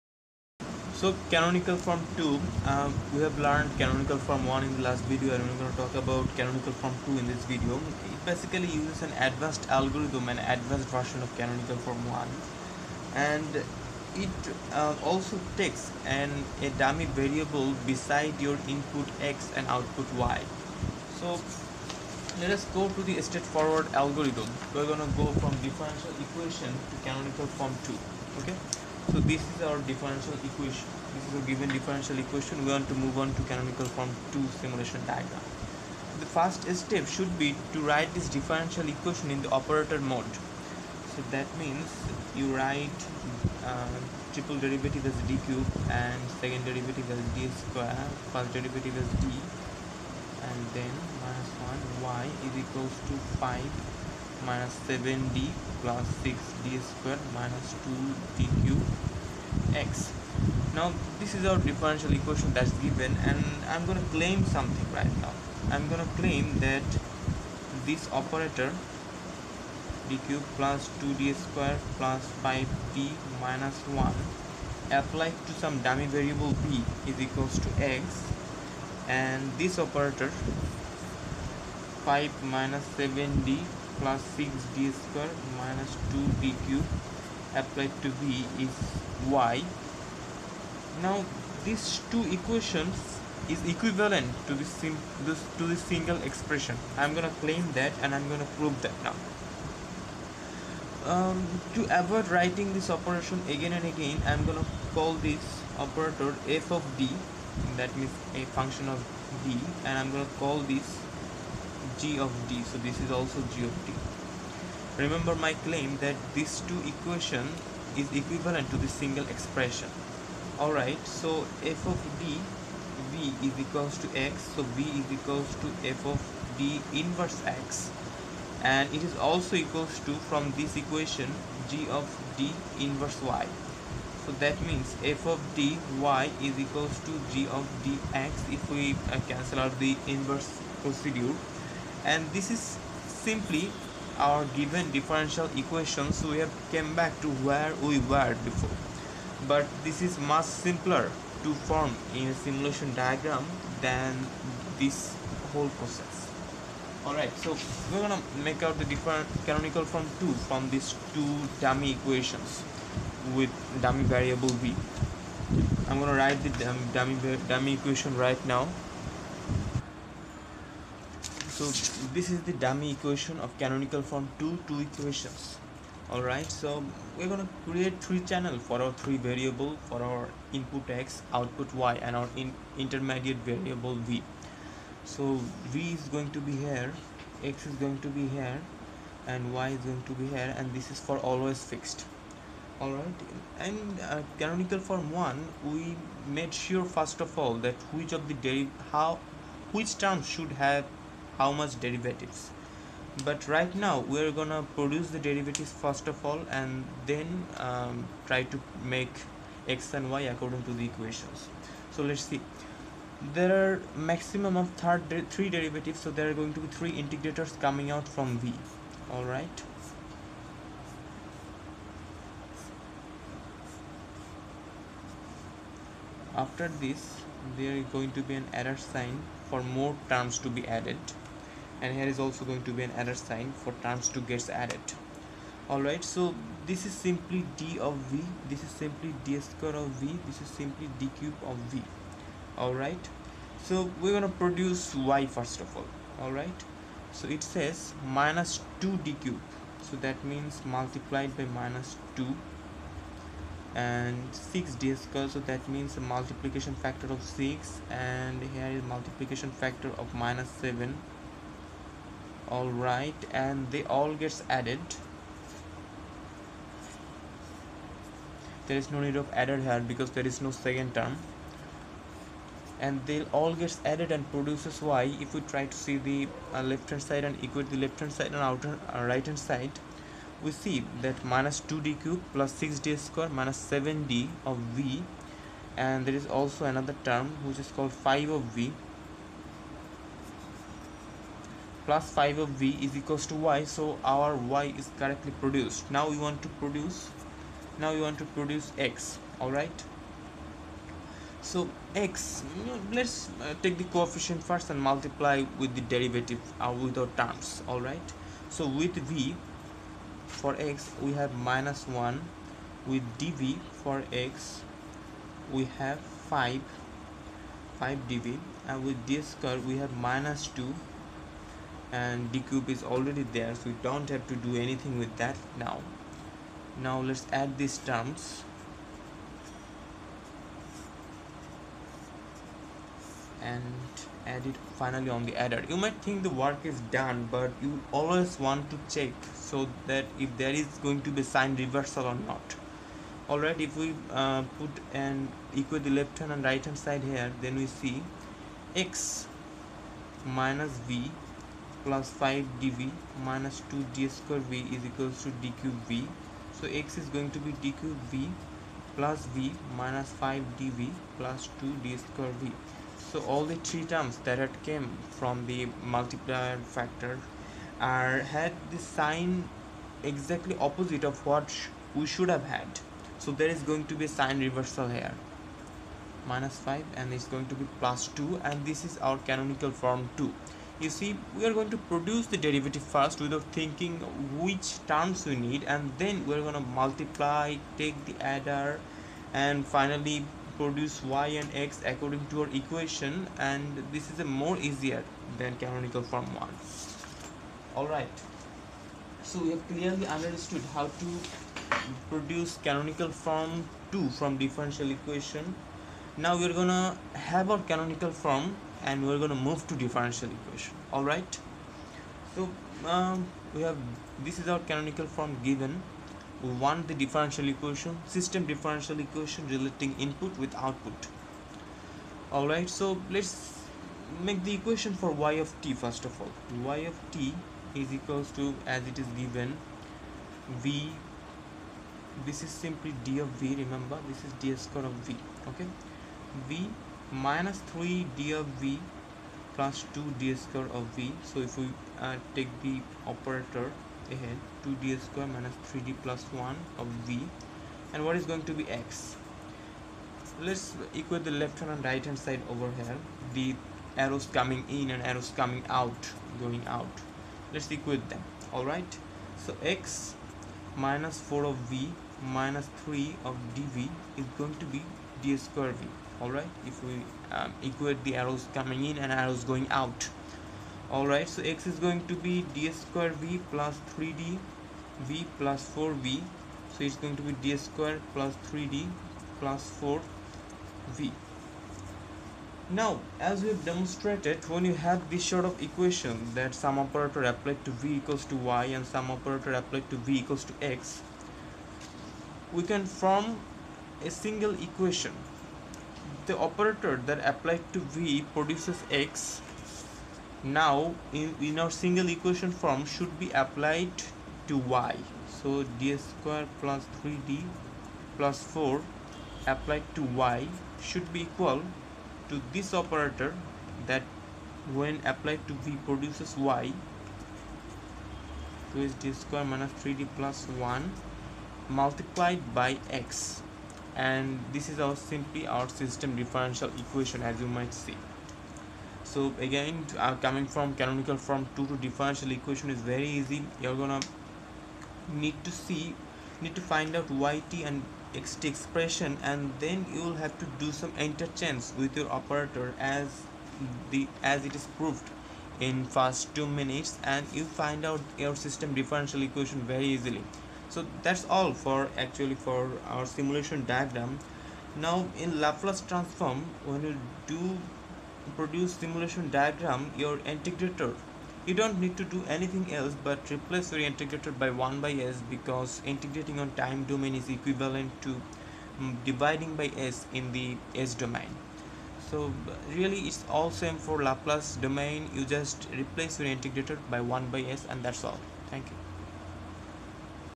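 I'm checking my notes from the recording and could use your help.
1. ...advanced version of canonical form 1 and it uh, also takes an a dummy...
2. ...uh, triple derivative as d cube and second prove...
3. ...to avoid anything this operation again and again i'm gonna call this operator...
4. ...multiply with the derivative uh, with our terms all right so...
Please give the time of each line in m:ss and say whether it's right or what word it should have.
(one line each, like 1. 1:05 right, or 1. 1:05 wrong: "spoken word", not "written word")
1. 0:10 right
2. 0:43 wrong: "derivative", not "prove"
3. 1:41 wrong: "writing", not "anything"
4. 5:04 right.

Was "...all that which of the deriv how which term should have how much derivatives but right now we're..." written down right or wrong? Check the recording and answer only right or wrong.
right.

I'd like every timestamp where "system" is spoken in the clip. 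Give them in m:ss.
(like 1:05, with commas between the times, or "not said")
6:58, 8:45, 9:08.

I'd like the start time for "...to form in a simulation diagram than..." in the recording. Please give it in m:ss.
2:31.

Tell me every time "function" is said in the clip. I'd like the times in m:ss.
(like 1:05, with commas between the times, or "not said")
1:48.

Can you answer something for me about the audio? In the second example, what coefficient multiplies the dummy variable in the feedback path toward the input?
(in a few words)
4.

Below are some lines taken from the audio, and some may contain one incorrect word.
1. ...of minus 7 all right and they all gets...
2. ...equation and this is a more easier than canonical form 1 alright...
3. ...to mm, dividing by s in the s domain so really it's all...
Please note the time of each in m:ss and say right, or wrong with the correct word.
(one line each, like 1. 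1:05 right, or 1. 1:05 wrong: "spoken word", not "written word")
1. 4:19 right
2. 6:32 right
3. 9:28 right.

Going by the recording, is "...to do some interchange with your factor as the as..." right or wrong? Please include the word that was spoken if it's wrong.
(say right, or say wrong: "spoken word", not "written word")
wrong: "operator", not "factor".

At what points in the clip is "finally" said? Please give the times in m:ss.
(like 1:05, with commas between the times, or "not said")
5:34, 6:29.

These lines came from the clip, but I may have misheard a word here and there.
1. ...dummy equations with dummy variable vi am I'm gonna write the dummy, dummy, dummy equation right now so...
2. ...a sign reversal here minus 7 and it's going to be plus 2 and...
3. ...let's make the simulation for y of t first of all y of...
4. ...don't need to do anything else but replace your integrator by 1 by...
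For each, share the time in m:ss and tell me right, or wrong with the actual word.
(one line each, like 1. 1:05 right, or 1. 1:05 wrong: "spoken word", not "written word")
1. 2:41 right
2. 6:14 wrong: "5", not "7"
3. 7:03 wrong: "equation", not "simulation"
4. 9:21 right.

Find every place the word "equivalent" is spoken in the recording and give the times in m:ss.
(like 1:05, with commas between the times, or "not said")
1:33, 1:58, 9:27.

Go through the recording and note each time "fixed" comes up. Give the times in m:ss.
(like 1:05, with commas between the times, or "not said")
3:11.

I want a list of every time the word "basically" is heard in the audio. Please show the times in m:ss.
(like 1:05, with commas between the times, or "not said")
0:08.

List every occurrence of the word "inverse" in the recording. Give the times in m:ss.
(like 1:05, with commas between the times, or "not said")
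2:06, 2:12, 2:20.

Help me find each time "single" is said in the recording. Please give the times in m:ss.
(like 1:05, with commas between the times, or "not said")
1:35, 1:58, 8:14, 8:21.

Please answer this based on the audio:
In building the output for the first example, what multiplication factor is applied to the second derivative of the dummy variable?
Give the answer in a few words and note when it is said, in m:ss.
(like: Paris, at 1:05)
6, at 4:16.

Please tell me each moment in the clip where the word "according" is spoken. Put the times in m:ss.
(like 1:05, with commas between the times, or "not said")
3:30, 6:31.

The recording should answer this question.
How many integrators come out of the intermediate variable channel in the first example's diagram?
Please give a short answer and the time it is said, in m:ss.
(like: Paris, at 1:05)
3, at 3:36.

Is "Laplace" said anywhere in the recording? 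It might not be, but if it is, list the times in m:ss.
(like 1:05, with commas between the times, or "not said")
9:15, 9:34.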